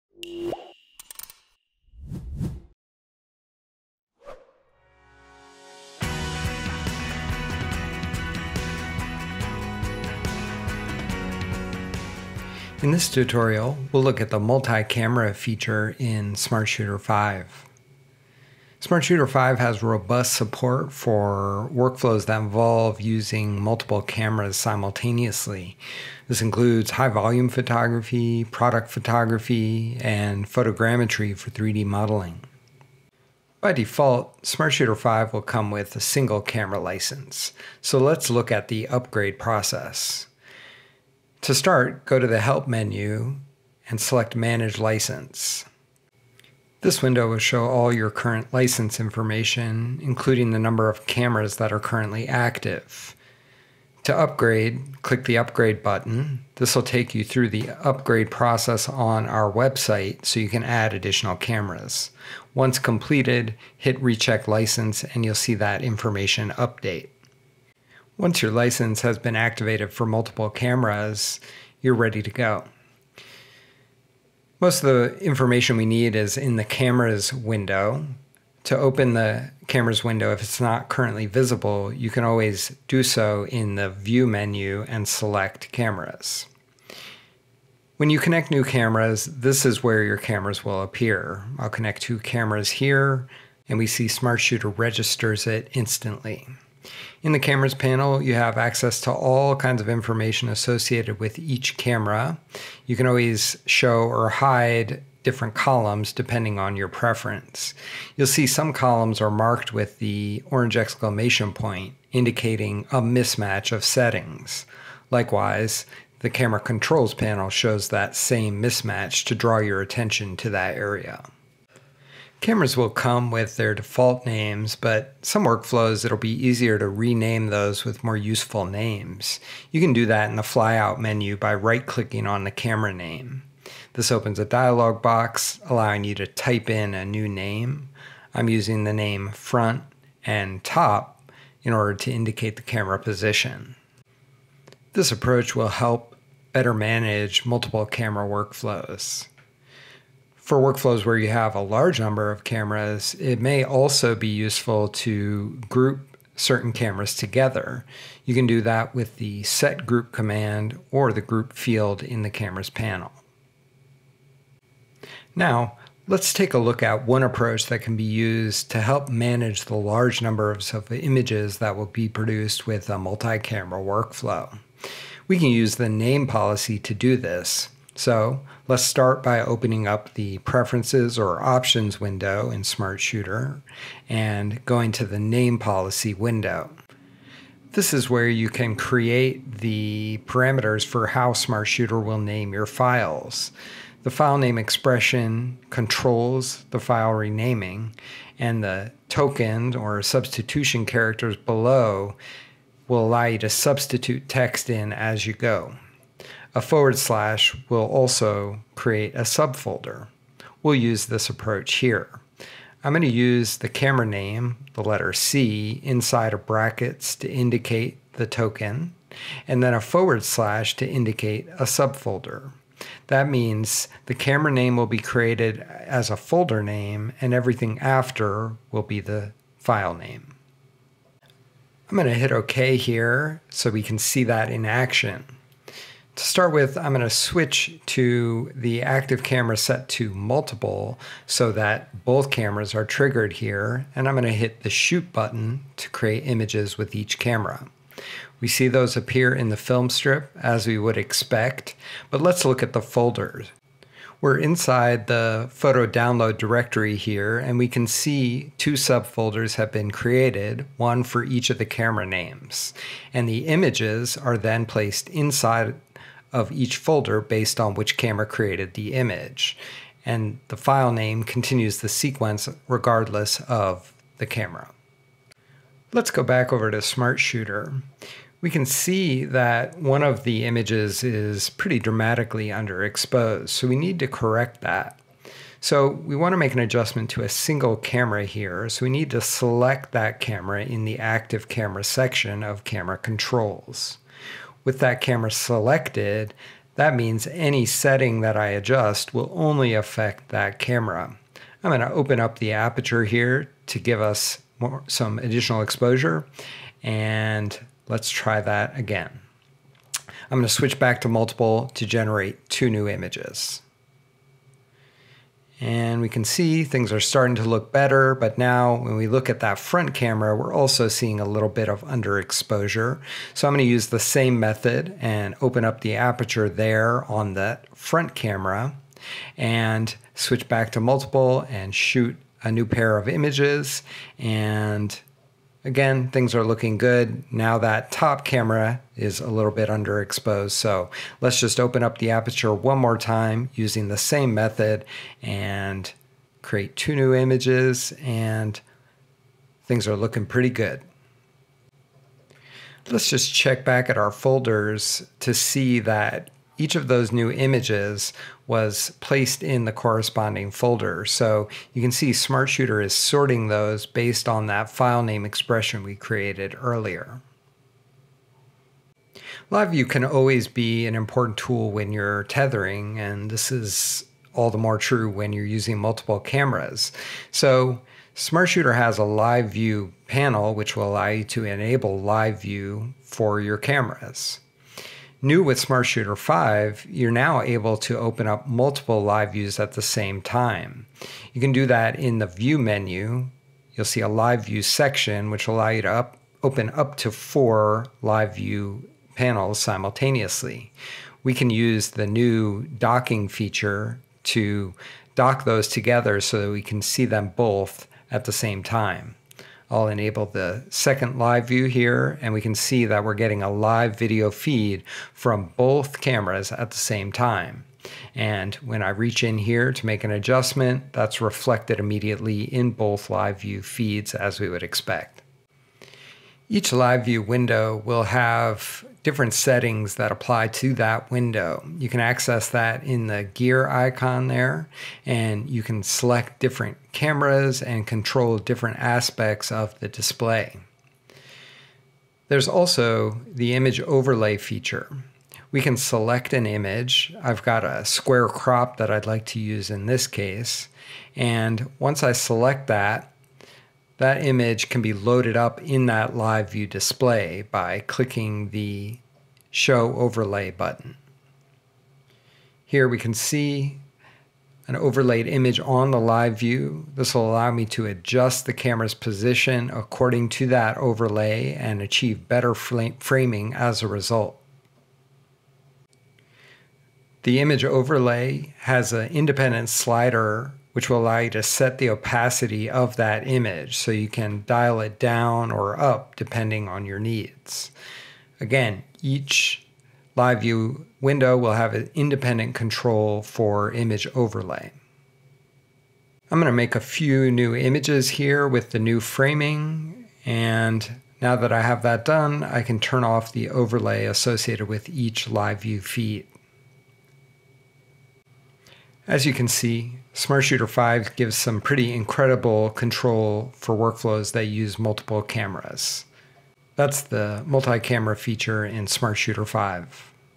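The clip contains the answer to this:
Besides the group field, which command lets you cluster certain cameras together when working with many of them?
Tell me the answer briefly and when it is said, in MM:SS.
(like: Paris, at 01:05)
set group, at 02:39.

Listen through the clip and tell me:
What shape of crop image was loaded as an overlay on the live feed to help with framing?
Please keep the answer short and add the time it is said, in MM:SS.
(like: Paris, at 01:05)
square, at 07:27.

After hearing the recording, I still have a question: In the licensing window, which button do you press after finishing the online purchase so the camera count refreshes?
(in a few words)
Recheck License.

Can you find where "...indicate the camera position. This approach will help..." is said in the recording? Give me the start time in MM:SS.
02:22.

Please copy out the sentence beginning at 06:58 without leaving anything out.
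And when I reach in here to make an adjustment, that's reflected immediately in both live view feeds as we would expect.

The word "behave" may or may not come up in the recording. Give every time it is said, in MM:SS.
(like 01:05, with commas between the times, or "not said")
not said.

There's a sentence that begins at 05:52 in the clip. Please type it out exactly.
Let's just check back at our folders to see that each of those new images was placed in the corresponding folder.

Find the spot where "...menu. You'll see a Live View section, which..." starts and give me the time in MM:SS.
06:32.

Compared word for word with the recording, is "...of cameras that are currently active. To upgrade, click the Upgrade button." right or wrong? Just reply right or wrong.
right.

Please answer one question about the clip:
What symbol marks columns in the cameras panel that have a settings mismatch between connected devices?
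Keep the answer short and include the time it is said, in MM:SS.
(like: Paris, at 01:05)
orange exclamation point, at 01:50.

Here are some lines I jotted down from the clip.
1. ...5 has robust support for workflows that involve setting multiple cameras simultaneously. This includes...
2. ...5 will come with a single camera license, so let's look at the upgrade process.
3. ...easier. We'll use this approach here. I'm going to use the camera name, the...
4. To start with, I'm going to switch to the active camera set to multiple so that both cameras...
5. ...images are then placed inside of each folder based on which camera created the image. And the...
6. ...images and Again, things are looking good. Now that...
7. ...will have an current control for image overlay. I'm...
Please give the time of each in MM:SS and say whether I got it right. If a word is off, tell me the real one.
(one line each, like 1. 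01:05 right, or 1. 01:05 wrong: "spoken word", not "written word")
1. 00:19 wrong: "using", not "setting"
2. 00:34 right
3. 03:29 wrong: "subfolder", not "easier"
4. 03:56 right
5. 04:23 right
6. 05:33 right
7. 08:11 wrong: "independent", not "current".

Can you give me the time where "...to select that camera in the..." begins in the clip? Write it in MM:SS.
04:49.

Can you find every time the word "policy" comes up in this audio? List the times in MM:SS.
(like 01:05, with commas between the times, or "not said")
02:56, 03:05.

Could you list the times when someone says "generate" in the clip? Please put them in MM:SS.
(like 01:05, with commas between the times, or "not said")
05:11.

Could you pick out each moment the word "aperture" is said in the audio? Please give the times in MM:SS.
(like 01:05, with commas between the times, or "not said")
05:02, 05:25, 05:42.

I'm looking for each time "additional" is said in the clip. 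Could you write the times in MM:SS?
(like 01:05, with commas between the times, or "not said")
01:00, 05:05.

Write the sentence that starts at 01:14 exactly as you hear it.
Most of the information we need is in the cameras window.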